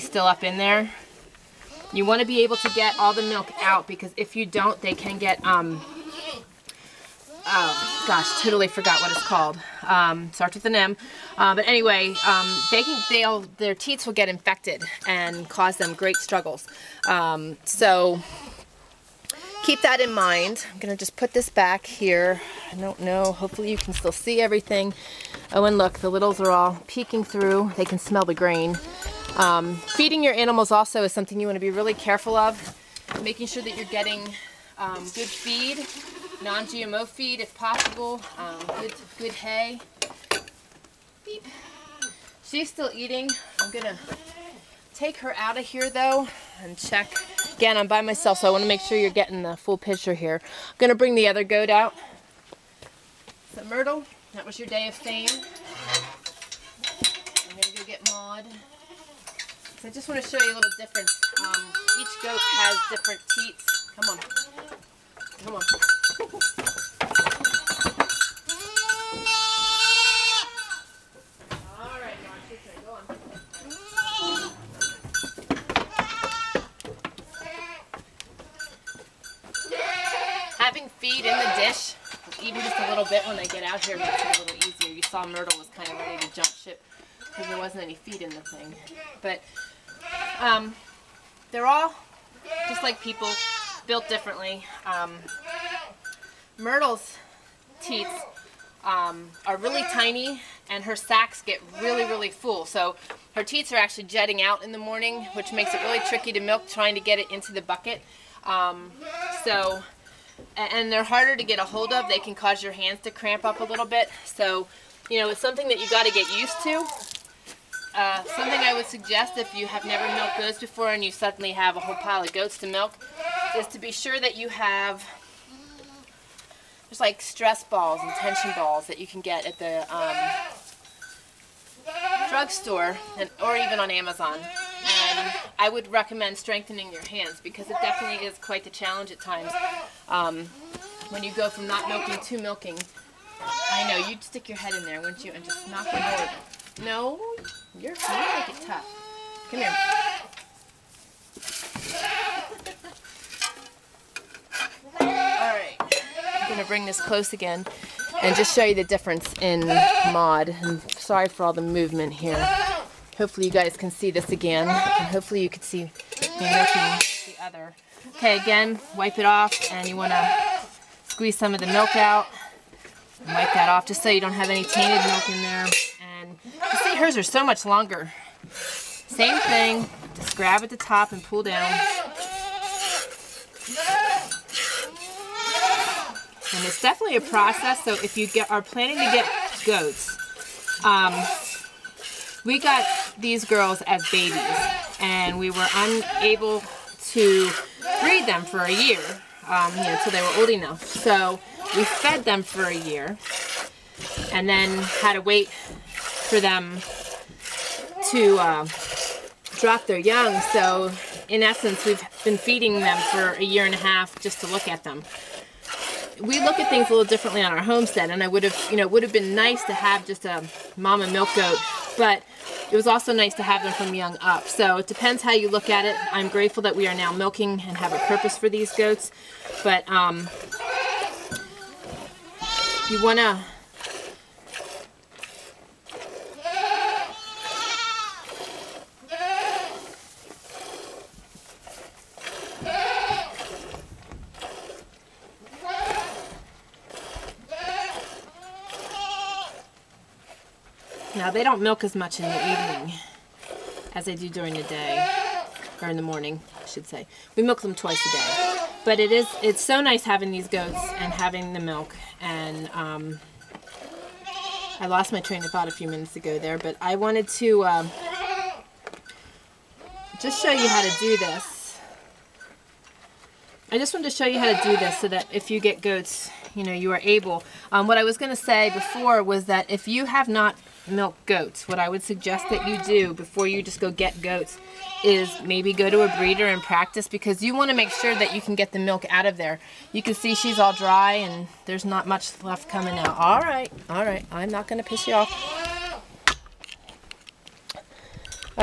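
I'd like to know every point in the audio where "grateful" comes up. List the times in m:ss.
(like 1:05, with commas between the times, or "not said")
3:46.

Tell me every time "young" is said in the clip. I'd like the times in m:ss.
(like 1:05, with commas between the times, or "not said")
3:29, 3:43.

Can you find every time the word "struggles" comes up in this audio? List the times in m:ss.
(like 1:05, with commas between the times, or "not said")
0:16.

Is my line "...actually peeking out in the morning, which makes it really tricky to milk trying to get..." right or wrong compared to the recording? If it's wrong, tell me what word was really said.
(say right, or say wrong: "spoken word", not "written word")
wrong: "jetting", not "peeking".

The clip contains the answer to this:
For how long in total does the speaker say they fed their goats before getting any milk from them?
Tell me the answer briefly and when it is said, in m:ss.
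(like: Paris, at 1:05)
a year and a half, at 3:33.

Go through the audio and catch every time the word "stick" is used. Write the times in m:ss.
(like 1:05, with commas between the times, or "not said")
2:24.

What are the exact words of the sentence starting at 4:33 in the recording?
I just wanted to show you how to do this so that if you get goats, you know, you are able.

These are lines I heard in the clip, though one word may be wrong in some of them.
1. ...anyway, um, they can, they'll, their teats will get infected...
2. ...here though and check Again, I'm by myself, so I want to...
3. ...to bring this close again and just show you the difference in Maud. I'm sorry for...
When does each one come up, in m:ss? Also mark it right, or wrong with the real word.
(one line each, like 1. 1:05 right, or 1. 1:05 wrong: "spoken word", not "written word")
1. 0:11 right
2. 0:45 right
3. 2:36 right.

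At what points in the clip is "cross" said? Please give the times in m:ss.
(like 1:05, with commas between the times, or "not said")
not said.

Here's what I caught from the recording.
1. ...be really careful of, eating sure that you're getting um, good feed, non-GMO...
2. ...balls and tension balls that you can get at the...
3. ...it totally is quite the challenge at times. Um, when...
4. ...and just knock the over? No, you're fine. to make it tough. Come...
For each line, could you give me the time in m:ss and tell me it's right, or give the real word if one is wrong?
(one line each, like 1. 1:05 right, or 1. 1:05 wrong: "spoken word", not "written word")
1. 0:31 wrong: "making", not "eating"
2. 2:07 right
3. 2:17 wrong: "definitely", not "totally"
4. 2:25 right.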